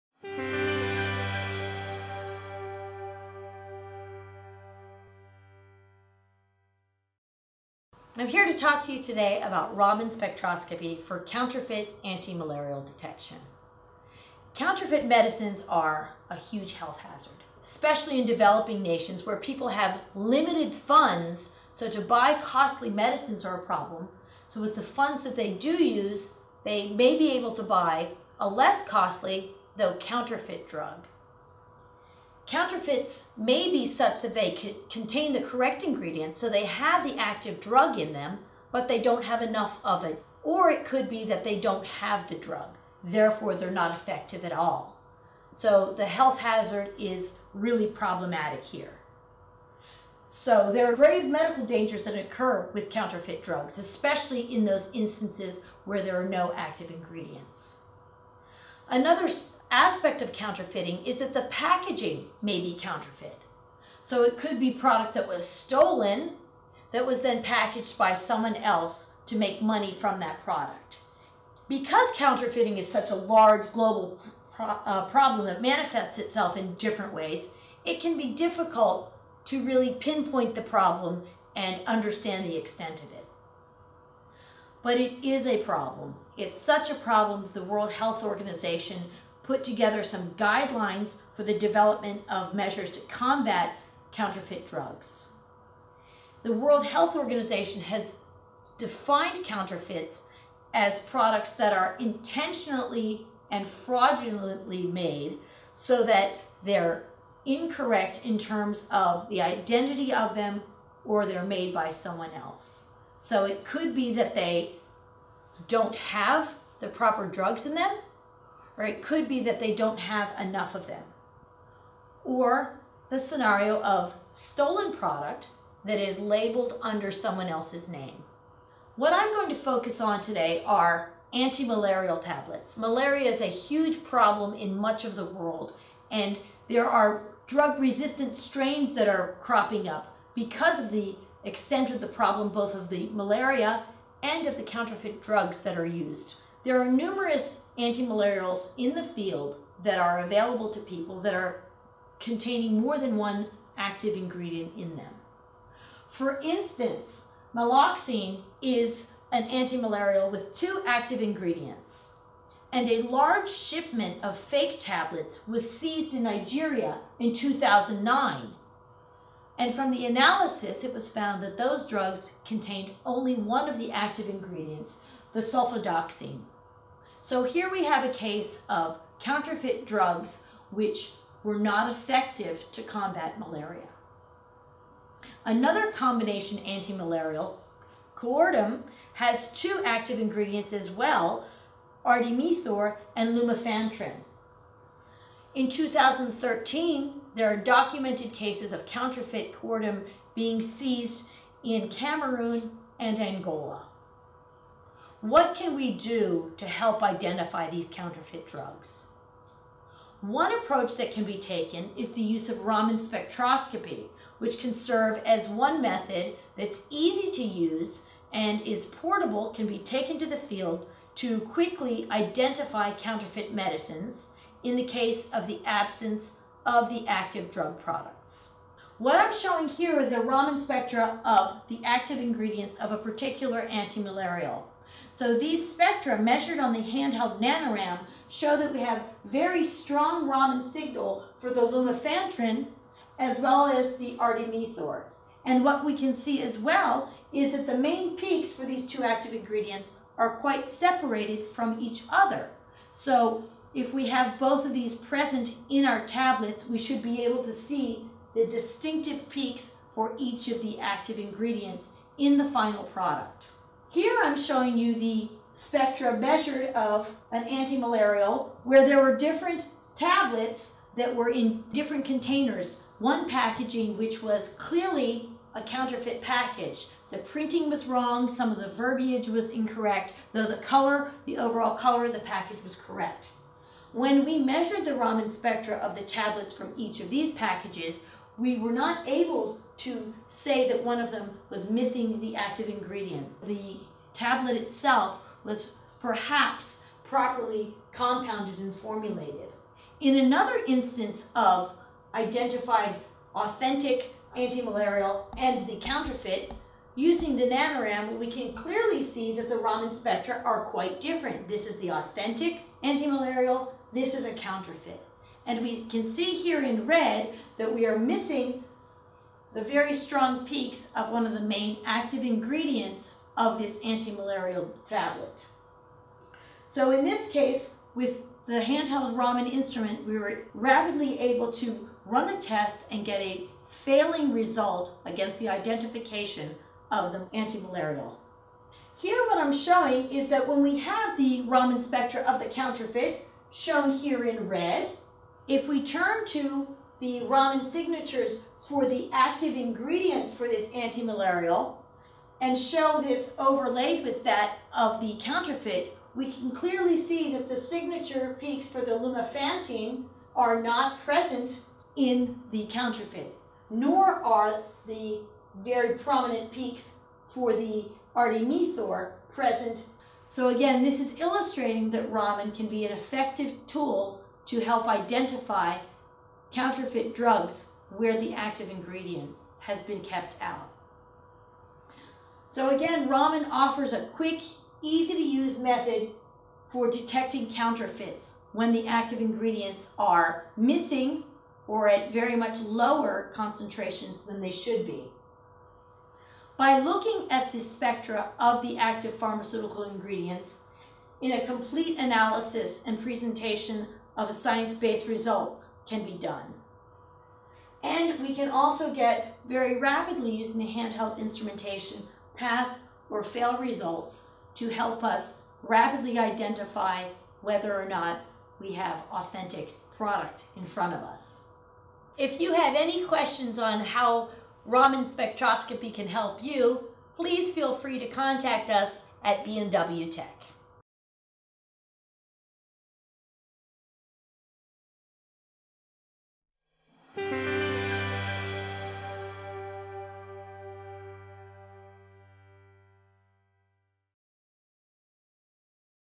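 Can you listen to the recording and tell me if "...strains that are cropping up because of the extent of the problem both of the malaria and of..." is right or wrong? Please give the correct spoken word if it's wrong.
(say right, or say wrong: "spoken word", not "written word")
right.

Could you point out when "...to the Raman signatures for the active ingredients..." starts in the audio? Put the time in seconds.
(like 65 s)
346 s.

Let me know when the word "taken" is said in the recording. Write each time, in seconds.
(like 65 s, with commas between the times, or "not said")
211 s, 219 s.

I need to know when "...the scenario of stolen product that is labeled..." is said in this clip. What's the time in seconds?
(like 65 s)
123 s.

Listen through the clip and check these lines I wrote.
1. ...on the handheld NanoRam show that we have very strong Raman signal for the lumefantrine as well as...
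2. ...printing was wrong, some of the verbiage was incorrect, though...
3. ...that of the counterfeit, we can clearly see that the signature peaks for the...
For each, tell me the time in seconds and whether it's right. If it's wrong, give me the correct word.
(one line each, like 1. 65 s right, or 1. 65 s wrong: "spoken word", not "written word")
1. 236 s right
2. 277 s right
3. 354 s right.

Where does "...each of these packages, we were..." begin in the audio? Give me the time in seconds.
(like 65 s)
286 s.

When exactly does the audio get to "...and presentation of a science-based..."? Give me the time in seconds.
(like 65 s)
402 s.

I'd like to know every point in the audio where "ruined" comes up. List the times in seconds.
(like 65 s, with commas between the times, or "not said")
not said.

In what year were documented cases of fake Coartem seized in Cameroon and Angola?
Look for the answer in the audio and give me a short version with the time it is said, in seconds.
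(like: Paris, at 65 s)
2013, at 195 s.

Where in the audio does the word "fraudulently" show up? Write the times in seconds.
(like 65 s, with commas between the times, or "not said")
103 s.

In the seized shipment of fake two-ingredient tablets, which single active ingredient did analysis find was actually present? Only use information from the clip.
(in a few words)
sulfadoxine.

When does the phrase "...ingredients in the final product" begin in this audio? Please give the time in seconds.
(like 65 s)
261 s.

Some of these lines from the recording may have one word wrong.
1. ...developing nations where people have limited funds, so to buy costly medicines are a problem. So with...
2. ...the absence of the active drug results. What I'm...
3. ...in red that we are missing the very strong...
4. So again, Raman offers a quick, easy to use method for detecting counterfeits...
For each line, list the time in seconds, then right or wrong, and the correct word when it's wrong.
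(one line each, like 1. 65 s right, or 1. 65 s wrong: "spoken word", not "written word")
1. 18 s right
2. 225 s wrong: "products", not "results"
3. 316 s right
4. 382 s right.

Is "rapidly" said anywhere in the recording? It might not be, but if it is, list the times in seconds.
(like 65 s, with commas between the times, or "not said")
330 s, 409 s, 415 s.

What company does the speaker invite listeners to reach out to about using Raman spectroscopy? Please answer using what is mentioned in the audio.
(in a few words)
B&W Tek.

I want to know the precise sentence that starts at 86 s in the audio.
It's such a problem that the World Health Organization put together some guidelines for the development of measures to combat counterfeit drugs.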